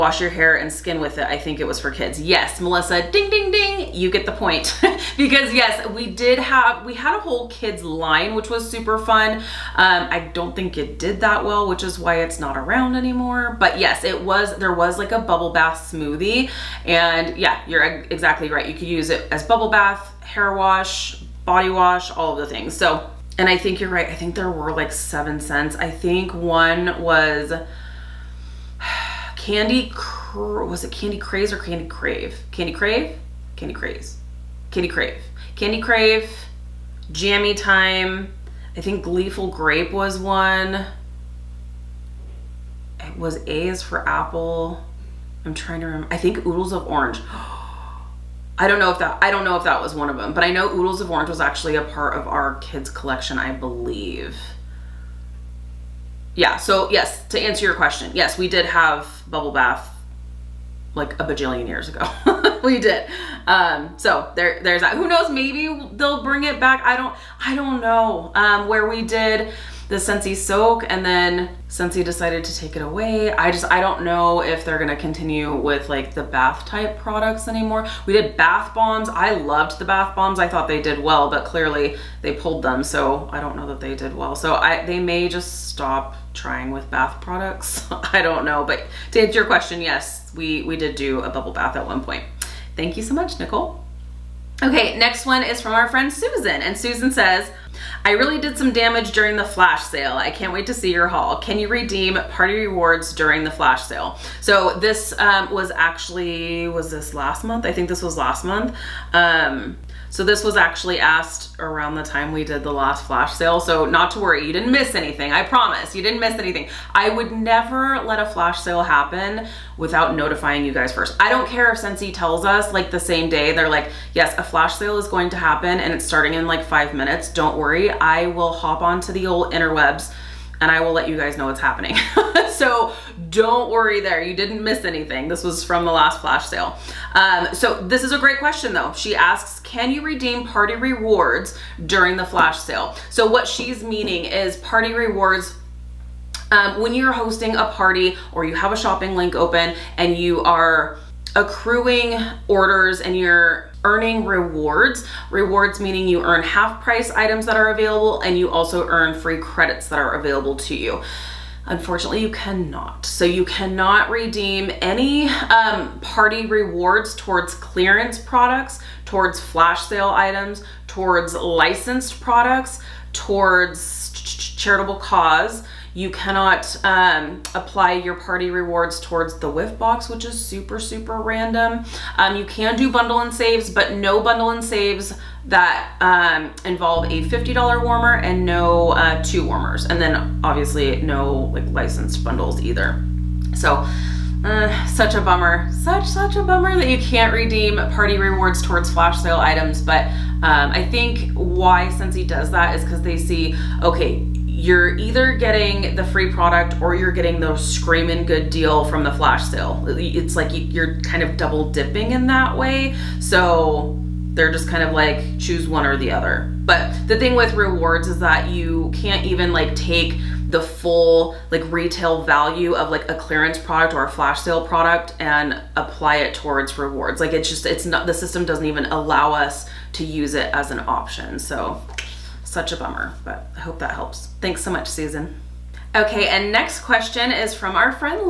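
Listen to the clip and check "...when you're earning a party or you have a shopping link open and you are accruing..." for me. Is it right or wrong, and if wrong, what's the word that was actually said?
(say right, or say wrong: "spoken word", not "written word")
wrong: "hosting", not "earning".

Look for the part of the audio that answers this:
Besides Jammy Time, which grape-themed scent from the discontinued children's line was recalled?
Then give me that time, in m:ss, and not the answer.
0:39.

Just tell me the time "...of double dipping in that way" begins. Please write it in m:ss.
3:31.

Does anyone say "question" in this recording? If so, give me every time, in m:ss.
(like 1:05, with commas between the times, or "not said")
0:57, 1:29, 2:18, 3:56.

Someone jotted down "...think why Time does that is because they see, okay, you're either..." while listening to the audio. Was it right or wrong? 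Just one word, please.
wrong.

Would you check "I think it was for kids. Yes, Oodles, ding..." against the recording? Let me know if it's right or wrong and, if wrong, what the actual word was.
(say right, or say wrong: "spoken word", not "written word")
wrong: "Melissa", not "Oodles".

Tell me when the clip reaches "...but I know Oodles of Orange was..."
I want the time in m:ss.
0:50.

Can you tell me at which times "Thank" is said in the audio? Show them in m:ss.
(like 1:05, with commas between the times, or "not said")
1:32, 3:54.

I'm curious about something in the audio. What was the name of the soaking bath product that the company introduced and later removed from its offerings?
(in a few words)
Scentsy soak.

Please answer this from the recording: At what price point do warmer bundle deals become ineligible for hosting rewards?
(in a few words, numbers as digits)
$50.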